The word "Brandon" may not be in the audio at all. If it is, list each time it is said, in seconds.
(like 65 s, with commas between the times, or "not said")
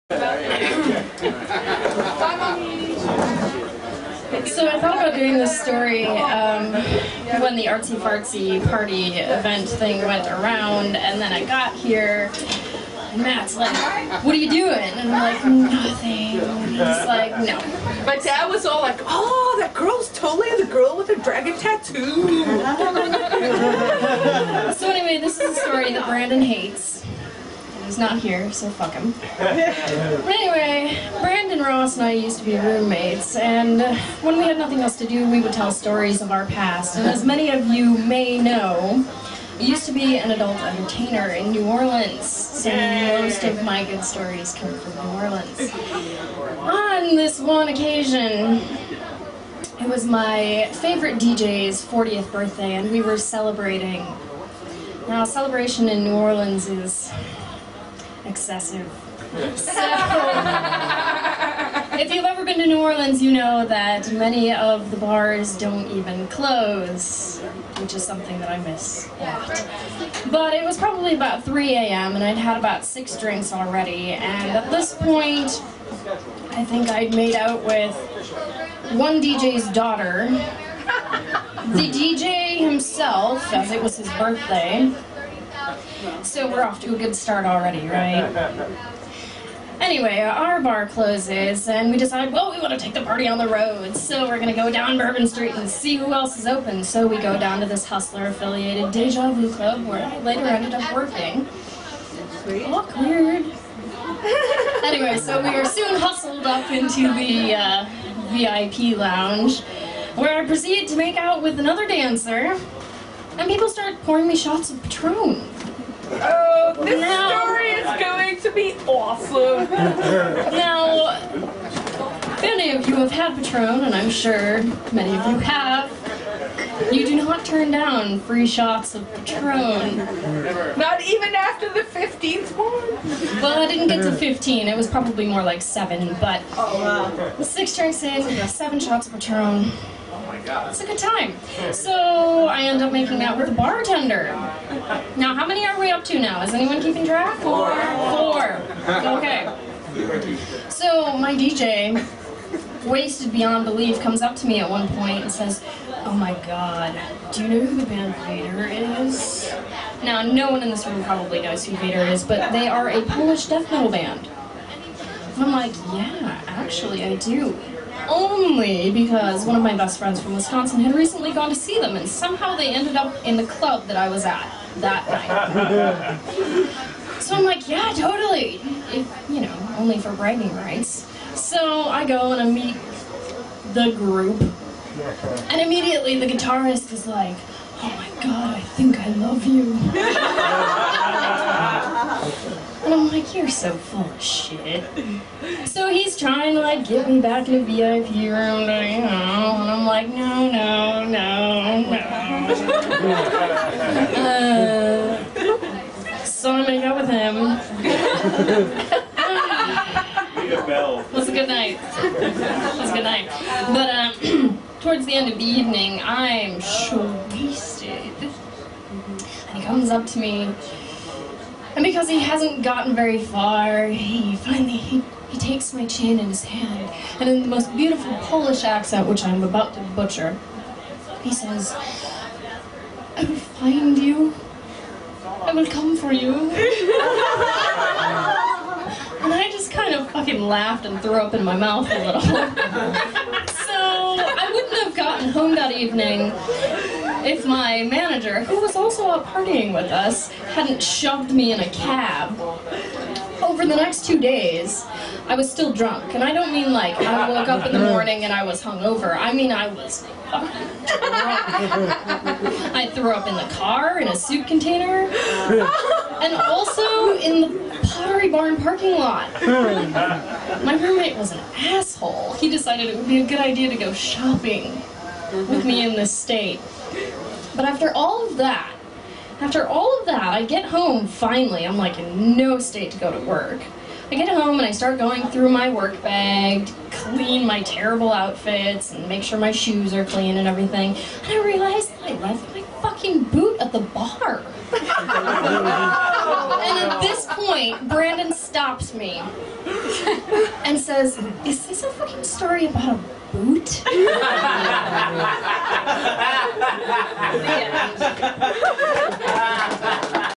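26 s, 31 s, 297 s.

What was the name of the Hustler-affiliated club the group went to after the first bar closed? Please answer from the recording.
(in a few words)
Deja Vu.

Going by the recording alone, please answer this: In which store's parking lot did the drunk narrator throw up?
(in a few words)
Pottery Barn.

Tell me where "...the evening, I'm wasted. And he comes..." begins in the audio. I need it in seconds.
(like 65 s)
215 s.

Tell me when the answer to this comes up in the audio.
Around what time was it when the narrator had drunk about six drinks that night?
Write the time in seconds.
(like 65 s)
71 s.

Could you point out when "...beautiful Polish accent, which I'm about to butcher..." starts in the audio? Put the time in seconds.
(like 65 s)
227 s.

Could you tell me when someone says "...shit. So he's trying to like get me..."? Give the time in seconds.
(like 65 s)
194 s.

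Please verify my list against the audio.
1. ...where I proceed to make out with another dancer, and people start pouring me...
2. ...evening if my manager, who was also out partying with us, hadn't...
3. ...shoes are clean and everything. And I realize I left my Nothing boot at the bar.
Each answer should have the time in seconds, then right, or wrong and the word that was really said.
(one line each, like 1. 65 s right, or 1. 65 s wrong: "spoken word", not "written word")
1. 110 s right
2. 245 s right
3. 289 s wrong: "fucking", not "Nothing".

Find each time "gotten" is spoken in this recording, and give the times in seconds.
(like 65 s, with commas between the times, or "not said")
222 s, 244 s.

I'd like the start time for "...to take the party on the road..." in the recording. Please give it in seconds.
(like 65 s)
92 s.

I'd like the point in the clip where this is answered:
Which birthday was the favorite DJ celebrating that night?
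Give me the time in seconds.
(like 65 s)
51 s.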